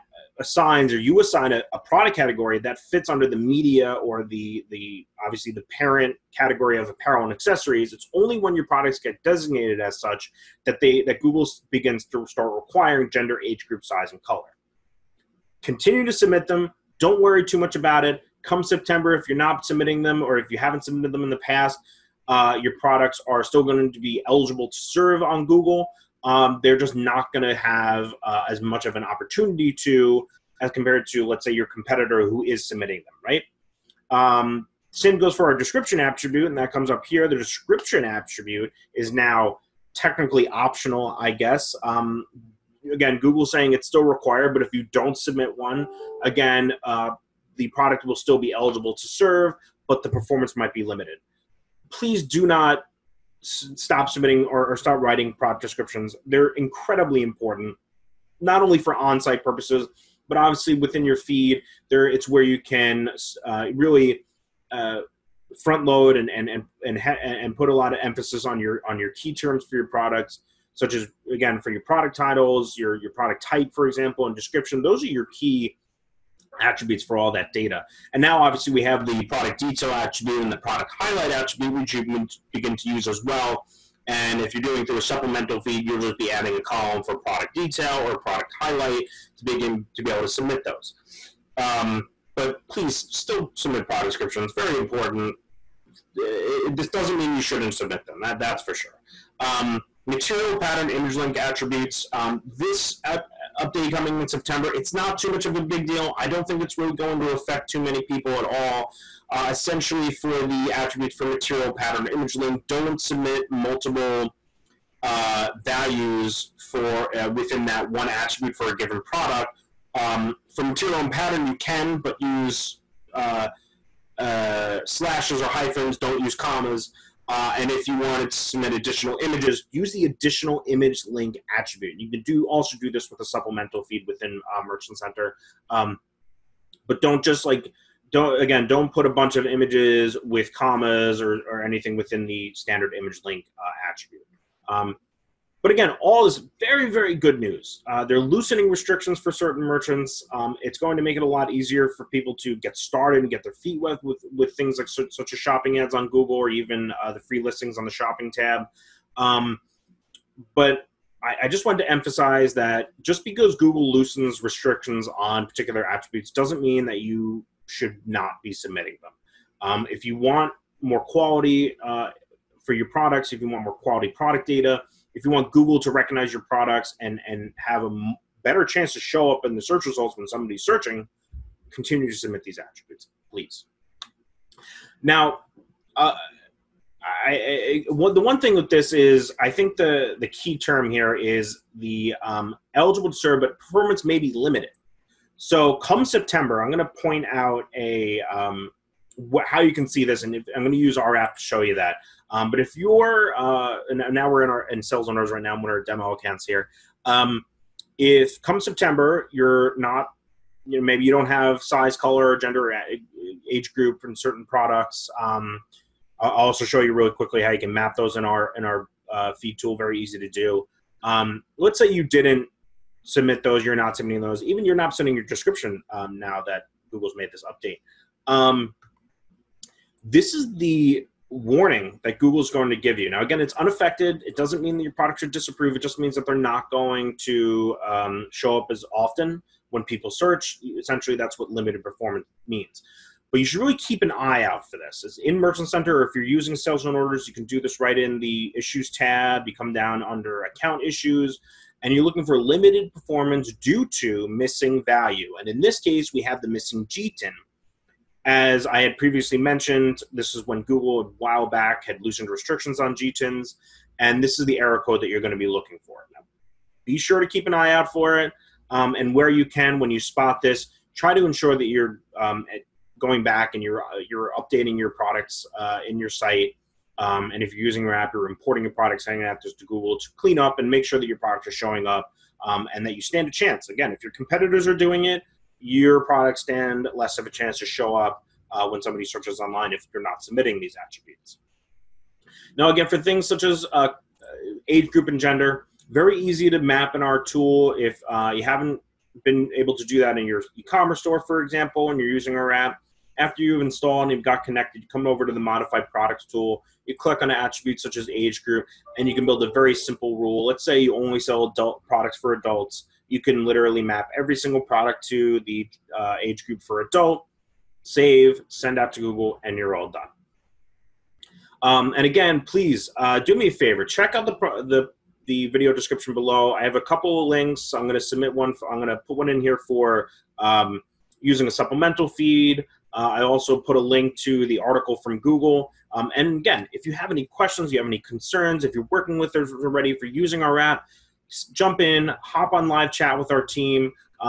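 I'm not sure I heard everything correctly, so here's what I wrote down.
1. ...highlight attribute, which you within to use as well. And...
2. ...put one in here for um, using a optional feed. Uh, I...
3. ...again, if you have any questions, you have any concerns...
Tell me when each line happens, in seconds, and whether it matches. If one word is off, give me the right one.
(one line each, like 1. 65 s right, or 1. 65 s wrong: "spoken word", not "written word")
1. 80 s wrong: "begin", not "within"
2. 329 s wrong: "supplemental", not "optional"
3. 336 s right.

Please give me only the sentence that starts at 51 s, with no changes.
Please do not s- stop submitting or, or stop writing product descriptions.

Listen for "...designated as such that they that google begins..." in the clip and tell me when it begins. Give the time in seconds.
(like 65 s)
9 s.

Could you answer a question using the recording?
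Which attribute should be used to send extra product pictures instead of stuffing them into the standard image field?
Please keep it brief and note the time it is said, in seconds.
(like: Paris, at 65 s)
Additional image link, at 130 s.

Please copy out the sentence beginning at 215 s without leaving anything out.
Um, I'll also show you really quickly how you can map those in our in our uh, feed tool.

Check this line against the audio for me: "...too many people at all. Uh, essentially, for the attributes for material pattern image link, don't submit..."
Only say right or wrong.
right.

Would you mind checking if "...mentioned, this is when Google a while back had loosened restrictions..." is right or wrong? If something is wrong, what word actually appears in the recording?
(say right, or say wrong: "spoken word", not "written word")
right.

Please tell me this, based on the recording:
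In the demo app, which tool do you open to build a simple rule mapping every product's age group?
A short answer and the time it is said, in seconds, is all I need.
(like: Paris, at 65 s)
Modified products tool, at 305 s.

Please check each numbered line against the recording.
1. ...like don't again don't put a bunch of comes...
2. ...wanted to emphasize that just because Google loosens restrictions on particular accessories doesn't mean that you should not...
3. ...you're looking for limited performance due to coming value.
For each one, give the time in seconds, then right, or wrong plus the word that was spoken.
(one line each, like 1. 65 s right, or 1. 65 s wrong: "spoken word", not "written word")
1. 137 s wrong: "images", not "comes"
2. 161 s wrong: "attributes", not "accessories"
3. 251 s wrong: "missing", not "coming".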